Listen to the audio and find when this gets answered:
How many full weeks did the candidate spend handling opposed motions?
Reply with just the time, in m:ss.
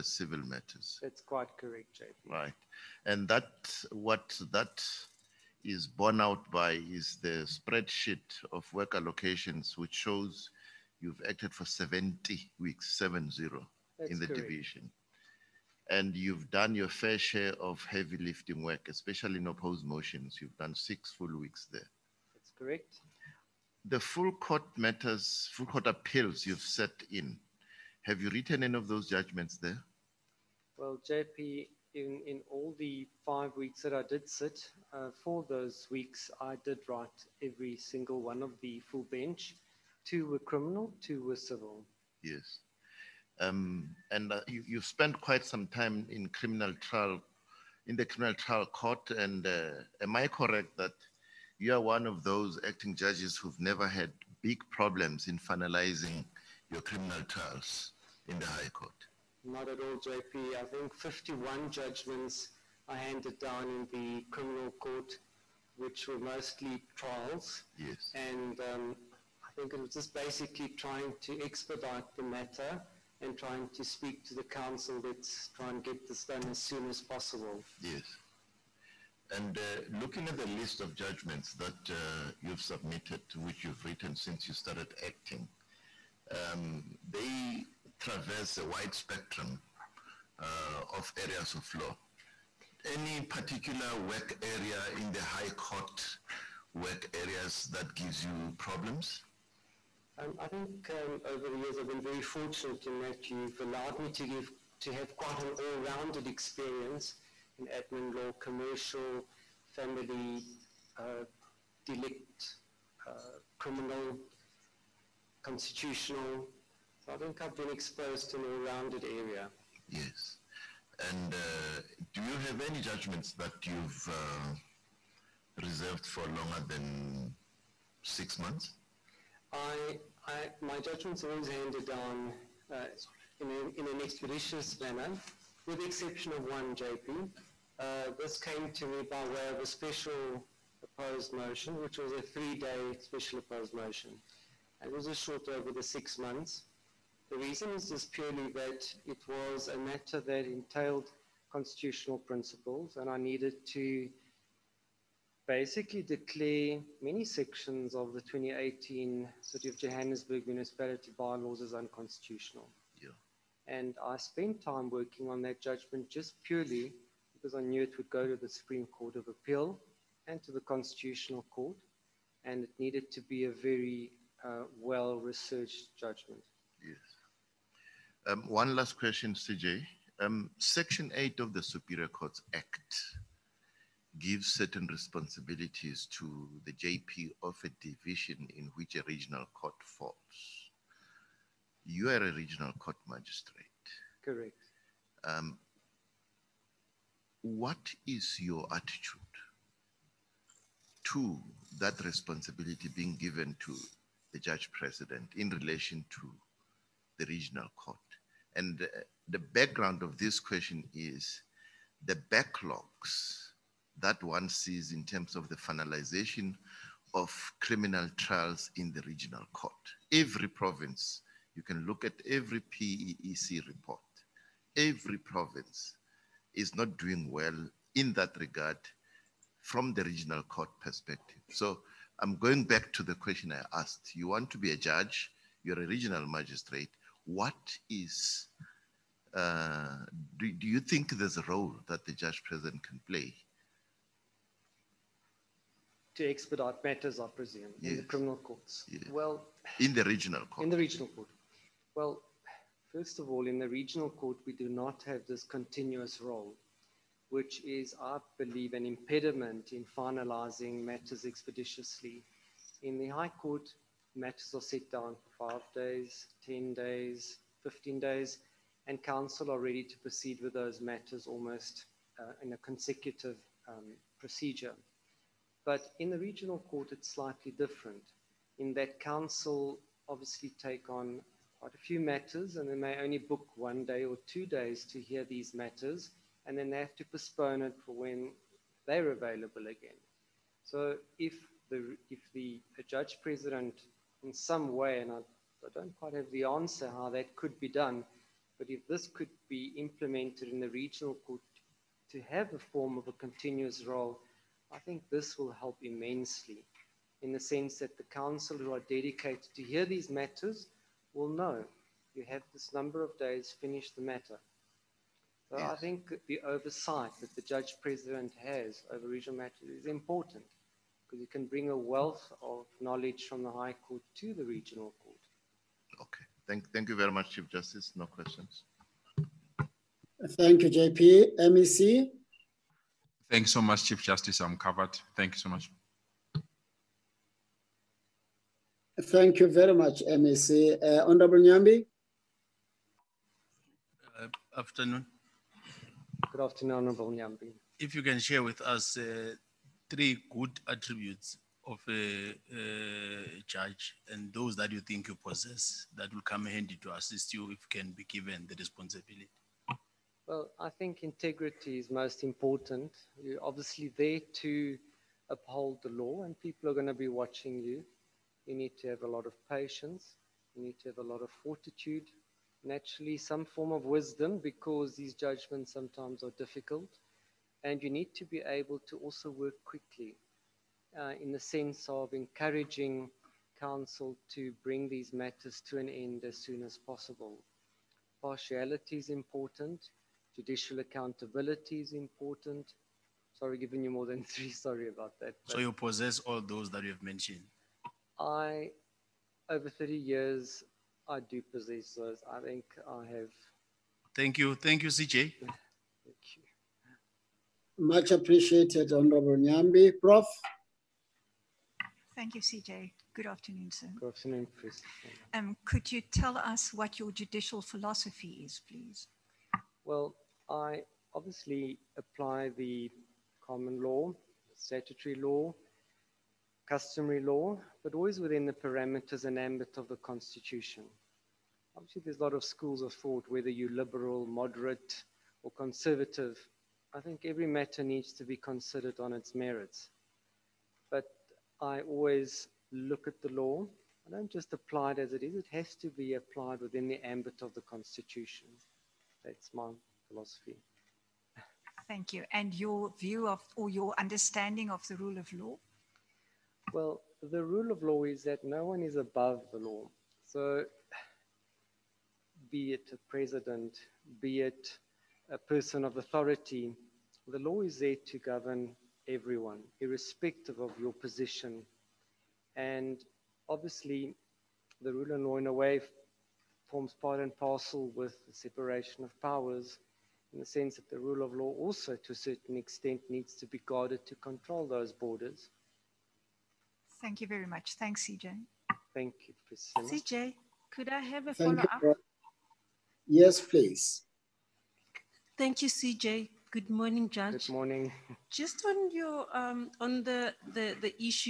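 0:20.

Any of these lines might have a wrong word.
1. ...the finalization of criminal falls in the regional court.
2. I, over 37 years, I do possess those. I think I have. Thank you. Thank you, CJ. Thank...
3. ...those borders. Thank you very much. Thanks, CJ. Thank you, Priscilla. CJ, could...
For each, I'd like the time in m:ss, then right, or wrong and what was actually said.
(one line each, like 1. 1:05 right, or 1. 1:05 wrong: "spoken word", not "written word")
1. 3:35 wrong: "trials", not "falls"
2. 6:38 wrong: "30", not "37"
3. 8:04 right.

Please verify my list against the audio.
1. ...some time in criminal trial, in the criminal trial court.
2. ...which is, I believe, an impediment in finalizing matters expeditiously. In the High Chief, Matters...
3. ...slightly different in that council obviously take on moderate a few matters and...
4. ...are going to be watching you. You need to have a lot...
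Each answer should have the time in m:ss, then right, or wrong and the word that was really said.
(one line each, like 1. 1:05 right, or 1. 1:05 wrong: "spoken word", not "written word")
1. 0:45 right
2. 4:17 wrong: "Court", not "Chief"
3. 4:37 wrong: "quite", not "moderate"
4. 6:06 right.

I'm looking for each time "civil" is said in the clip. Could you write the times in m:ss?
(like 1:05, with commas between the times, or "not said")
0:00, 0:41.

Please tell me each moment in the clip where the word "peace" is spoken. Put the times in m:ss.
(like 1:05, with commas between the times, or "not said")
not said.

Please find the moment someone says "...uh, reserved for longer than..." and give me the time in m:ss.
2:04.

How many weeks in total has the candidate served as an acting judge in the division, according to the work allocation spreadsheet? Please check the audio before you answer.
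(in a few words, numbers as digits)
70.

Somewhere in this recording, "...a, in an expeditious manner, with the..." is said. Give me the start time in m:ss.
2:13.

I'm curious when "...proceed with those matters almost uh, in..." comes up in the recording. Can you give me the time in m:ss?
4:30.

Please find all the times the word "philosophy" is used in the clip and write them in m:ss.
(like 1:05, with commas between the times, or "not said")
6:57, 7:30.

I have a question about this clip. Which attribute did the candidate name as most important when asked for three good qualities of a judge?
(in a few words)
Integrity.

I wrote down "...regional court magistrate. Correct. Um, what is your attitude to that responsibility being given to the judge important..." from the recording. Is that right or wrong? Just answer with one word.
wrong.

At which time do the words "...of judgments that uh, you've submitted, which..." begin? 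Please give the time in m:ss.
1:20.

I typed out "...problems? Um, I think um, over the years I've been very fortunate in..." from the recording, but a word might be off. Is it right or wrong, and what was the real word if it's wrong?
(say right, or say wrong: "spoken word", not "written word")
right.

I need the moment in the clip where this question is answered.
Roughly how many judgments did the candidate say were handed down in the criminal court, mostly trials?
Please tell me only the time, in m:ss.
1:01.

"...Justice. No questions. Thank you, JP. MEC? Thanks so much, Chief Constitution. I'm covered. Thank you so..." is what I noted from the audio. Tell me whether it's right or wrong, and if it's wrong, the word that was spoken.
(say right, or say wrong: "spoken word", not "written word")
wrong: "Justice", not "Constitution".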